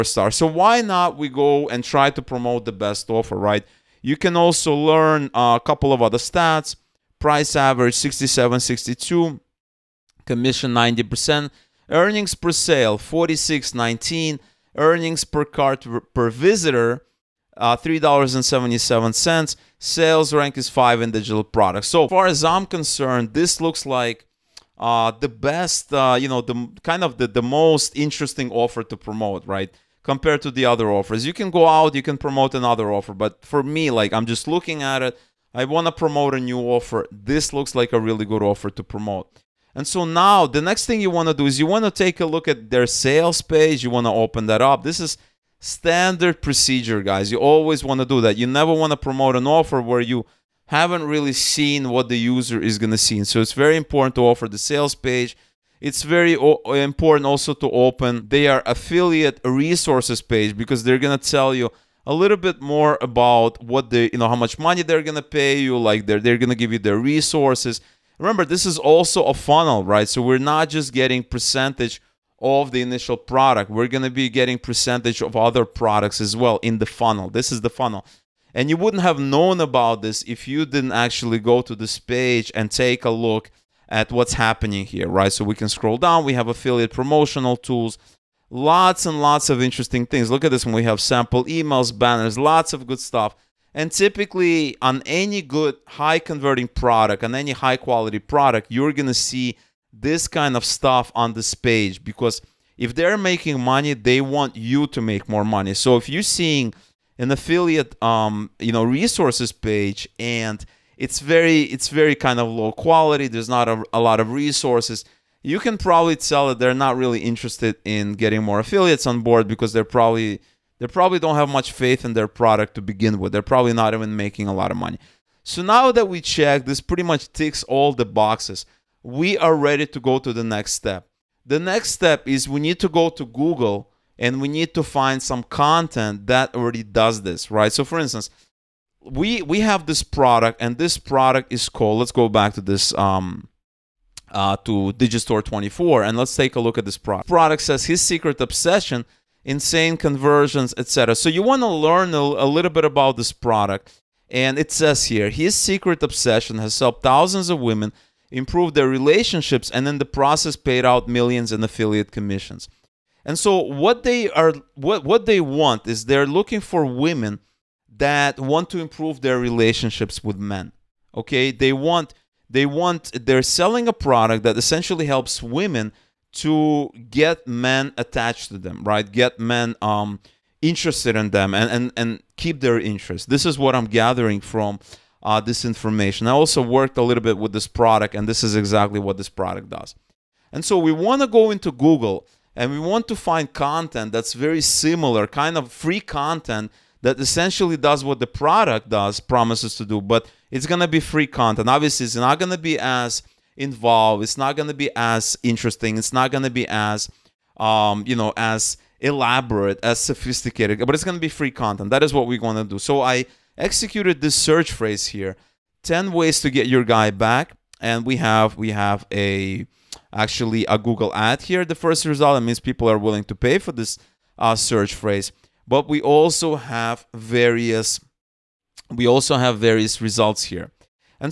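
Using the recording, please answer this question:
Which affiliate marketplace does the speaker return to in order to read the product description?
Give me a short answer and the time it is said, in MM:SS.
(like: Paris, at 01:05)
Digistore 24, at 02:24.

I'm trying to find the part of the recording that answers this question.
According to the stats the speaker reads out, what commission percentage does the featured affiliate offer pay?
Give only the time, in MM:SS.
00:10.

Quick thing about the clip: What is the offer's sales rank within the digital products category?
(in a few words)
5.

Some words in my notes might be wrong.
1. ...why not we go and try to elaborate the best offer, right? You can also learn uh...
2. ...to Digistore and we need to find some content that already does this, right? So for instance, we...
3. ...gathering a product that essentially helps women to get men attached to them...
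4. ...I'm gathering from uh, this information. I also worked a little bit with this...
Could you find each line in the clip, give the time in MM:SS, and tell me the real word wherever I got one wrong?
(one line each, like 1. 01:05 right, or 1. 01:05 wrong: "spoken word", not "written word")
1. 00:00 wrong: "promote", not "elaborate"
2. 02:13 wrong: "Google", not "Digistore"
3. 02:53 wrong: "selling", not "gathering"
4. 03:03 right.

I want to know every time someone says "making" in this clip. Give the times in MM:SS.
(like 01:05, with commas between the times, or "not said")
01:43, 02:04.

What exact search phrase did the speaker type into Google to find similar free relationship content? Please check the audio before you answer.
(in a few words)
10 ways to get your guy back.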